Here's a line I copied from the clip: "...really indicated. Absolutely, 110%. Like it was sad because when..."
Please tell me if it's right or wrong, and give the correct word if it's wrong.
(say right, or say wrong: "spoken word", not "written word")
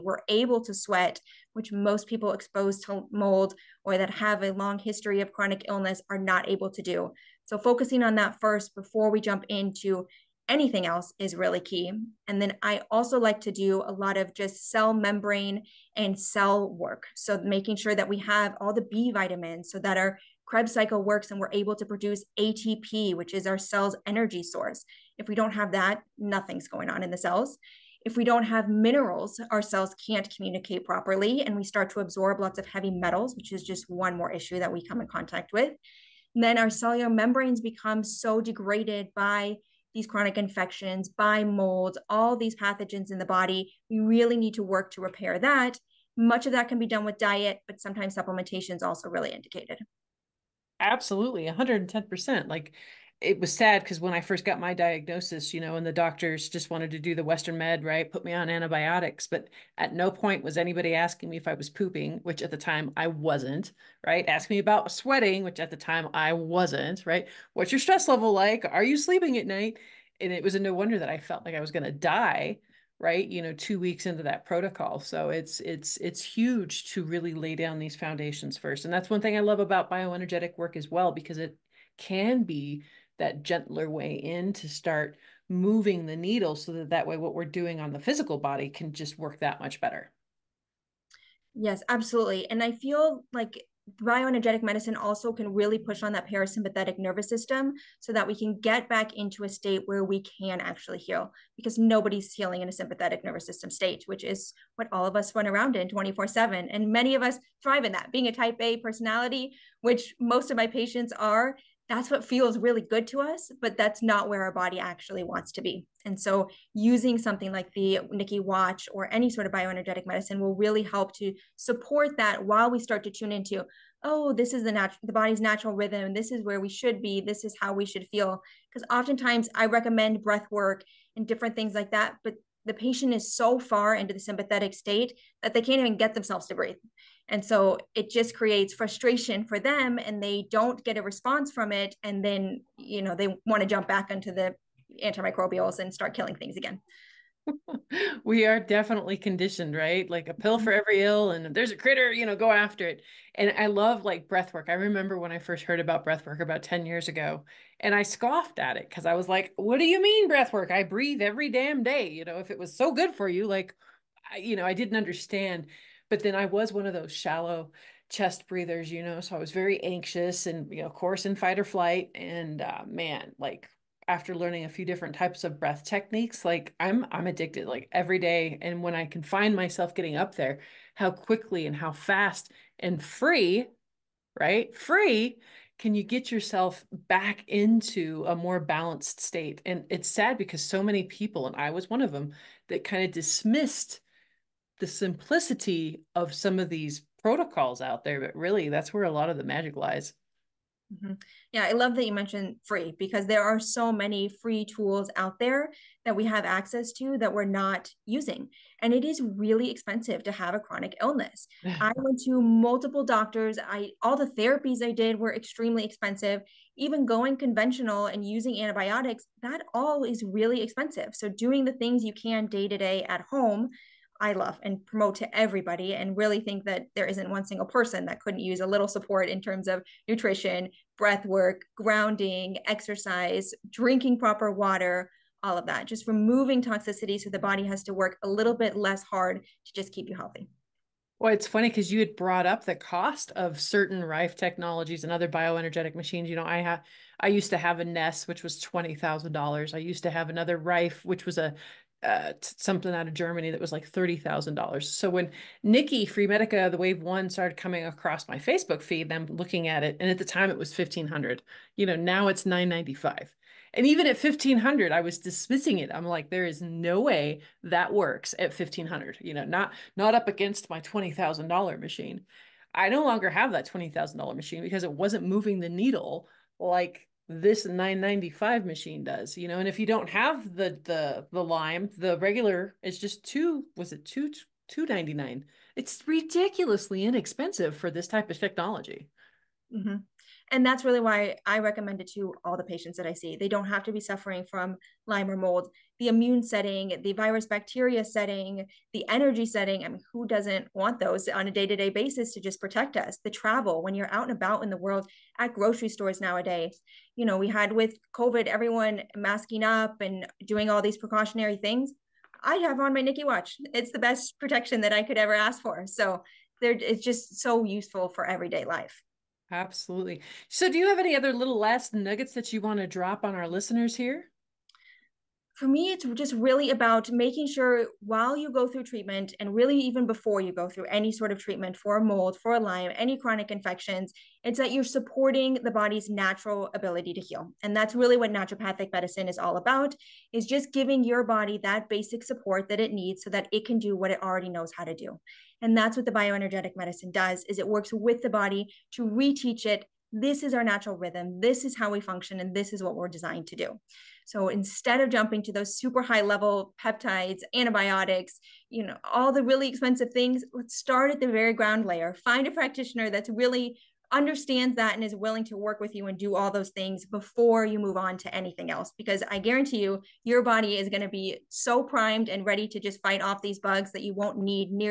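right.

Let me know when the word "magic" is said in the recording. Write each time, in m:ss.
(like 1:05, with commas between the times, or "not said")
3:19.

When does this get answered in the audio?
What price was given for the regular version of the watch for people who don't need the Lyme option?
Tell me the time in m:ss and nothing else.
4:44.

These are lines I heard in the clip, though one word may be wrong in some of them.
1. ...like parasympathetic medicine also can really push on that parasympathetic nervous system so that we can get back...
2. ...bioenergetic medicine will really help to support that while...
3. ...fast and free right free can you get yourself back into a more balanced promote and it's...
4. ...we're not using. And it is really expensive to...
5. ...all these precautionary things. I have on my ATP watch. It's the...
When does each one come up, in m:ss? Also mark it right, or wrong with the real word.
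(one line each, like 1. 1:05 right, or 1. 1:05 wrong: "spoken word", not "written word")
1. 1:33 wrong: "bioenergetic", not "parasympathetic"
2. 1:59 right
3. 3:01 wrong: "state", not "promote"
4. 3:27 right
5. 5:10 wrong: "Nikki", not "ATP".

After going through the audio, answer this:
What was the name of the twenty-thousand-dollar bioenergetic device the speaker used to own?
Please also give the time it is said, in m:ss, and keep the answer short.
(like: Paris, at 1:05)
Nest, at 4:07.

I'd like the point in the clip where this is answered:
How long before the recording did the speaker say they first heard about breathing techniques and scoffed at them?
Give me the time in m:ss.
2:36.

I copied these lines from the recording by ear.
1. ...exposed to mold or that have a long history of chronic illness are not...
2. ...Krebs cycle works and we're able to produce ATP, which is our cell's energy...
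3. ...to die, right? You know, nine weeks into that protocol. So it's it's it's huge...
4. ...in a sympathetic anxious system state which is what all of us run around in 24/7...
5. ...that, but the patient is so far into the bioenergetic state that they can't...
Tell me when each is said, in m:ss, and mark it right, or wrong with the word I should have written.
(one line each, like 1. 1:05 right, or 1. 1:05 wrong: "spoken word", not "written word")
1. 0:02 right
2. 0:20 right
3. 1:11 wrong: "two", not "nine"
4. 1:42 wrong: "nervous", not "anxious"
5. 2:11 wrong: "sympathetic", not "bioenergetic".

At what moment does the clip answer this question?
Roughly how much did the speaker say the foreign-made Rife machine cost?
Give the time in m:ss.
4:13.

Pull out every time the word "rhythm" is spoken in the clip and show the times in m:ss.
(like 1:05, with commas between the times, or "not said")
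2:05, 5:50.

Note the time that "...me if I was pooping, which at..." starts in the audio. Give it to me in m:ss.
1:01.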